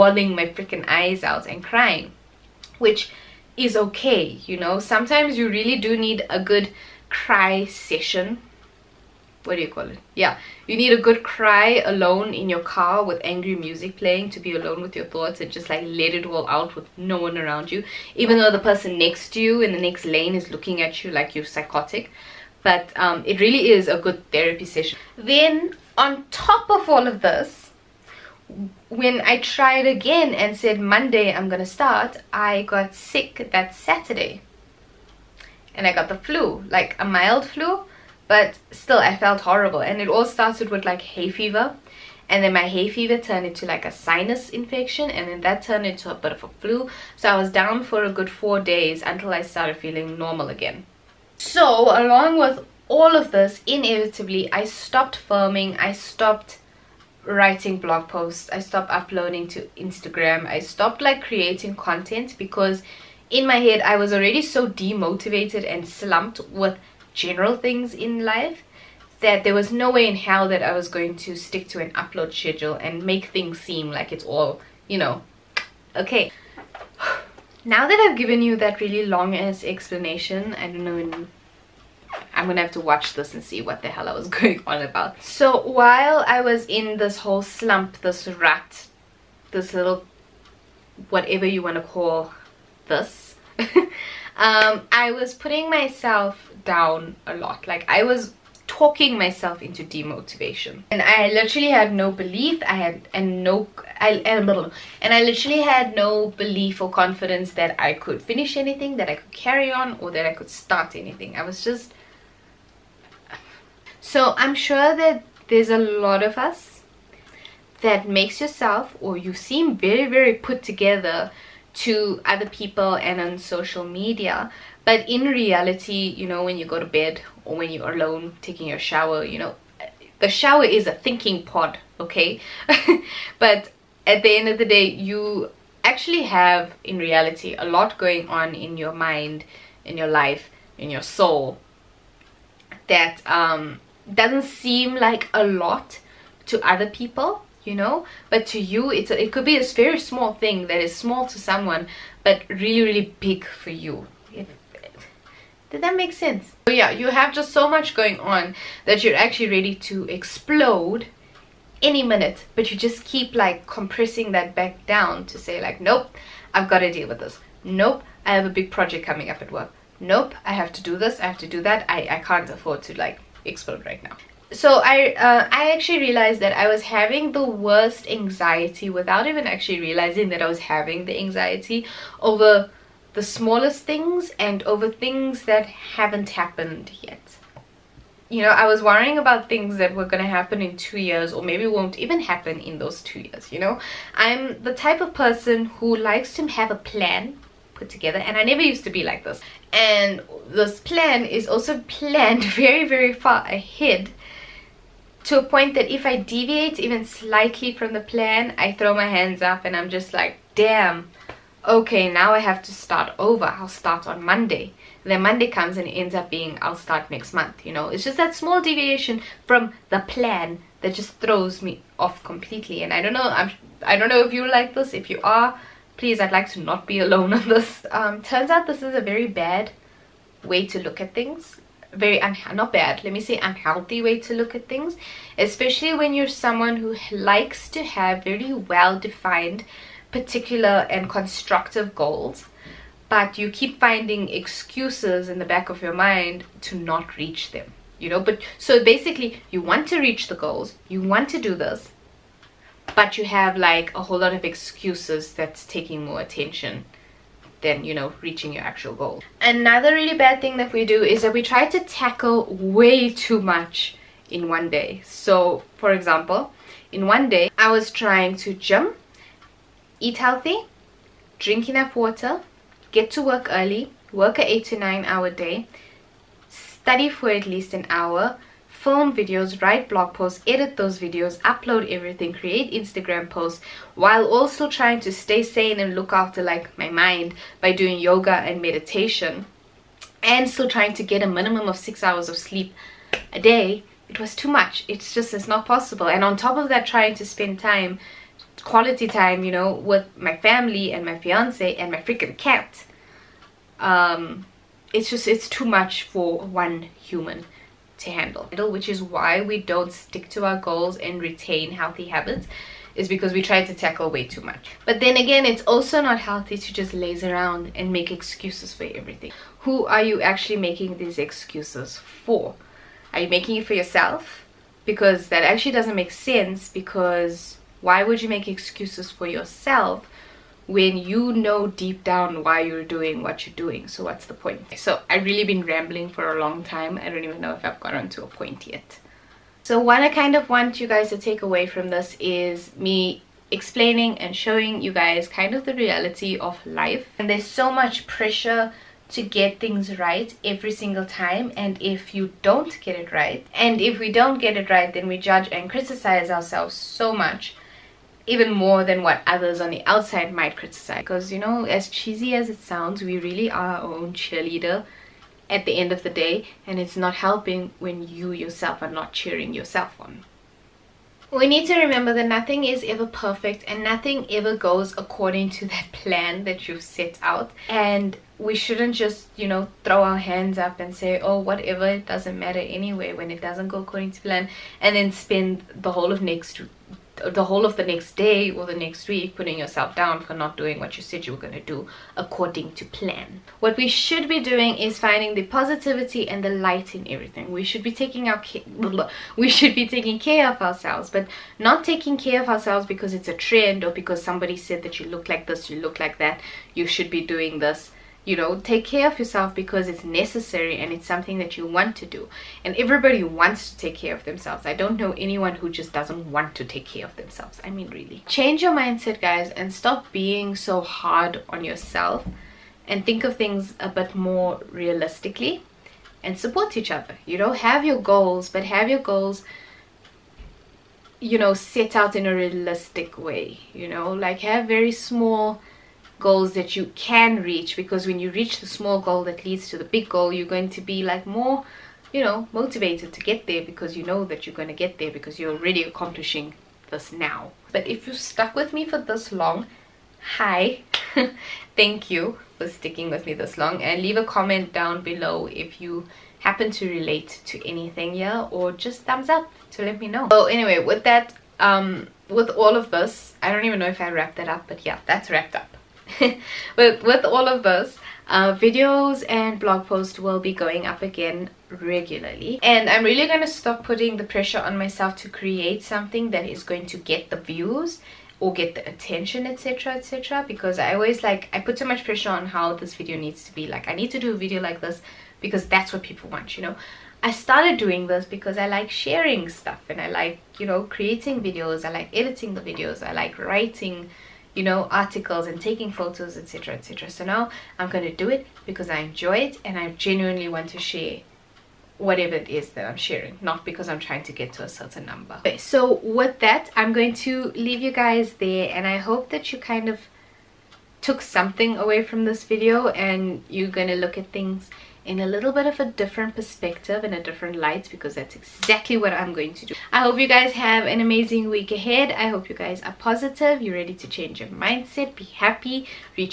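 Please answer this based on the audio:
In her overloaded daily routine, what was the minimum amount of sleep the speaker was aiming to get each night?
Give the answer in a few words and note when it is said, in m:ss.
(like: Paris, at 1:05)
6 hours, at 4:51.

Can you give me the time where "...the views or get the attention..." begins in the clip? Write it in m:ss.
7:57.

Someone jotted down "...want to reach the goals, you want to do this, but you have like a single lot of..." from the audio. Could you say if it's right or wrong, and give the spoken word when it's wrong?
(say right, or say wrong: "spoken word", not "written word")
wrong: "whole", not "single".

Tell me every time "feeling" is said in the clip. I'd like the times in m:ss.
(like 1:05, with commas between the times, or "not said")
0:49.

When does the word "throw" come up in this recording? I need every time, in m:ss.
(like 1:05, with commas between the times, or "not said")
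3:28, 3:41, 6:19.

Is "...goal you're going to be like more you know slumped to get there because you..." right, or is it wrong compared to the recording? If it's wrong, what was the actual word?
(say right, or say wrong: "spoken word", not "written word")
wrong: "motivated", not "slumped".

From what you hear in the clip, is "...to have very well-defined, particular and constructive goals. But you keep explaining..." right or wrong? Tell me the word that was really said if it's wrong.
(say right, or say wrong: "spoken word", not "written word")
wrong: "finding", not "explaining".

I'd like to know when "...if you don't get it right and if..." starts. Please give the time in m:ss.
5:51.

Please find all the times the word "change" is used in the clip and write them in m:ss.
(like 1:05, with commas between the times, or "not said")
6:58, 8:44.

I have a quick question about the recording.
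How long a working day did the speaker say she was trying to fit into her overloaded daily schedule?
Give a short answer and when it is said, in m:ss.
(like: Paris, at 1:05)
8 to 9 hours, at 4:34.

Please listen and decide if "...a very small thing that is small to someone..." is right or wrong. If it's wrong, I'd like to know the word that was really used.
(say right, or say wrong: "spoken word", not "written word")
right.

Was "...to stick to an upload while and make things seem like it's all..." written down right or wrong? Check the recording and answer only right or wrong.
wrong.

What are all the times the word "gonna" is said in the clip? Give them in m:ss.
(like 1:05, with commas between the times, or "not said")
0:31, 1:22, 8:33.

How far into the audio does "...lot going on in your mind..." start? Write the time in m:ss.
2:17.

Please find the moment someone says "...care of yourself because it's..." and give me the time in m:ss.
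6:48.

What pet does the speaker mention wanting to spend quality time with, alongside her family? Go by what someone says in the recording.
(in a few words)
cat.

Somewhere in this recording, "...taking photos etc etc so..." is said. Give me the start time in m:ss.
8:15.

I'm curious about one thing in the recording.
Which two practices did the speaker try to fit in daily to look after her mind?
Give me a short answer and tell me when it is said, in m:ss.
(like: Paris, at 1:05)
yoga and meditation, at 4:47.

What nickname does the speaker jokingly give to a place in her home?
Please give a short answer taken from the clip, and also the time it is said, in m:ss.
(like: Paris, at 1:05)
thinking pod, at 2:10.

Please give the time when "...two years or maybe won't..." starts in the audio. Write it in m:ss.
3:10.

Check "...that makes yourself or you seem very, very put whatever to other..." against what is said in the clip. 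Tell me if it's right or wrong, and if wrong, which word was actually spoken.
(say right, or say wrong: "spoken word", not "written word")
wrong: "together", not "whatever".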